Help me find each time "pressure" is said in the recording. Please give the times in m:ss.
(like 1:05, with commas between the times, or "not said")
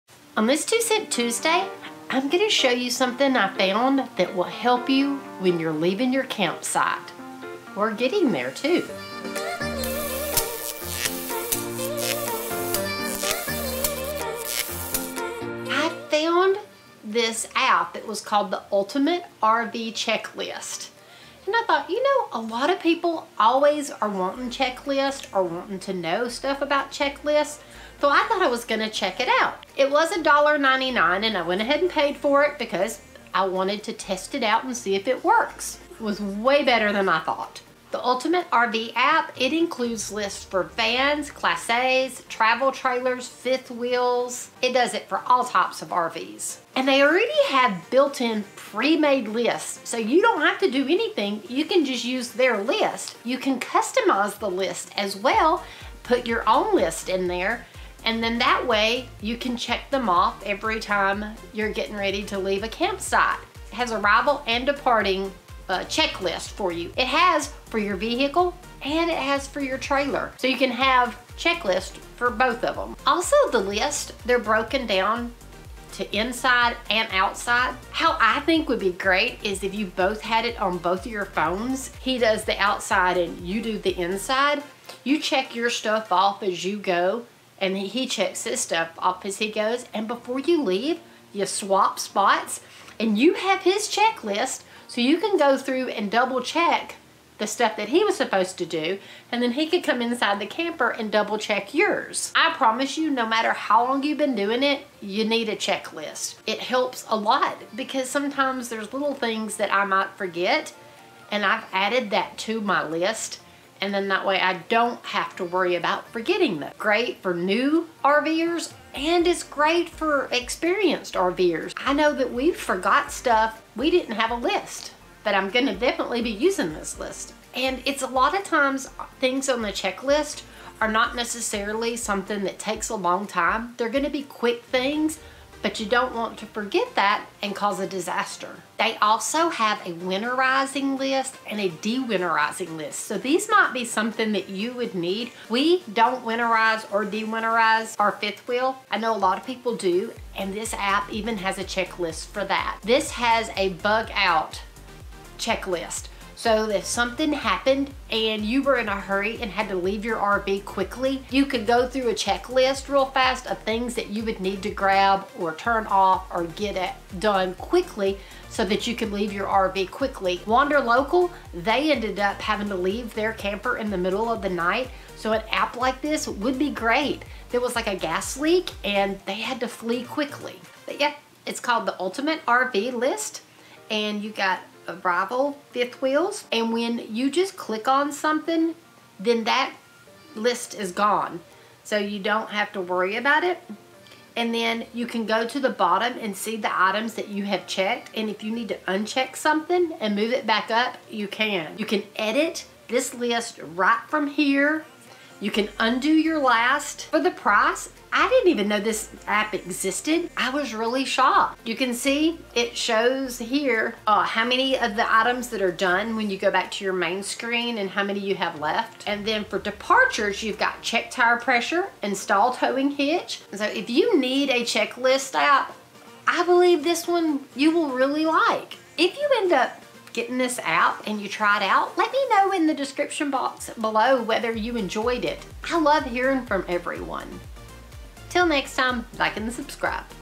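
3:41.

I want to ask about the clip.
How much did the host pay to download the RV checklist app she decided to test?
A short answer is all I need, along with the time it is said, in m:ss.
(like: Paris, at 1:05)
$1.99, at 0:30.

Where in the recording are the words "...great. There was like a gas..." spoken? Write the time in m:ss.
2:56.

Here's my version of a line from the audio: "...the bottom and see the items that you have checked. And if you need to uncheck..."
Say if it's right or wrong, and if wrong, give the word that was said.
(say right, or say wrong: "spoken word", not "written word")
right.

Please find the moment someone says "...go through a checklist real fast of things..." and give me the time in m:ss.
2:41.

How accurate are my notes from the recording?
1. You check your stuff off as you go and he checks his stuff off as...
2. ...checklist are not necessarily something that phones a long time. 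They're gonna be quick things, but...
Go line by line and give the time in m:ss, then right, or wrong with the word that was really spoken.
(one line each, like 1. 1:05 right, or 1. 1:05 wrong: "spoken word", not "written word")
1. 1:25 right
2. 2:09 wrong: "takes", not "phones".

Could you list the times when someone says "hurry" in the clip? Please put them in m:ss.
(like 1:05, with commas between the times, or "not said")
2:38.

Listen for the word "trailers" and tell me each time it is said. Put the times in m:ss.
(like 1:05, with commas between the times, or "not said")
0:42, 1:09.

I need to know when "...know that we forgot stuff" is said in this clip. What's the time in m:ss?
2:01.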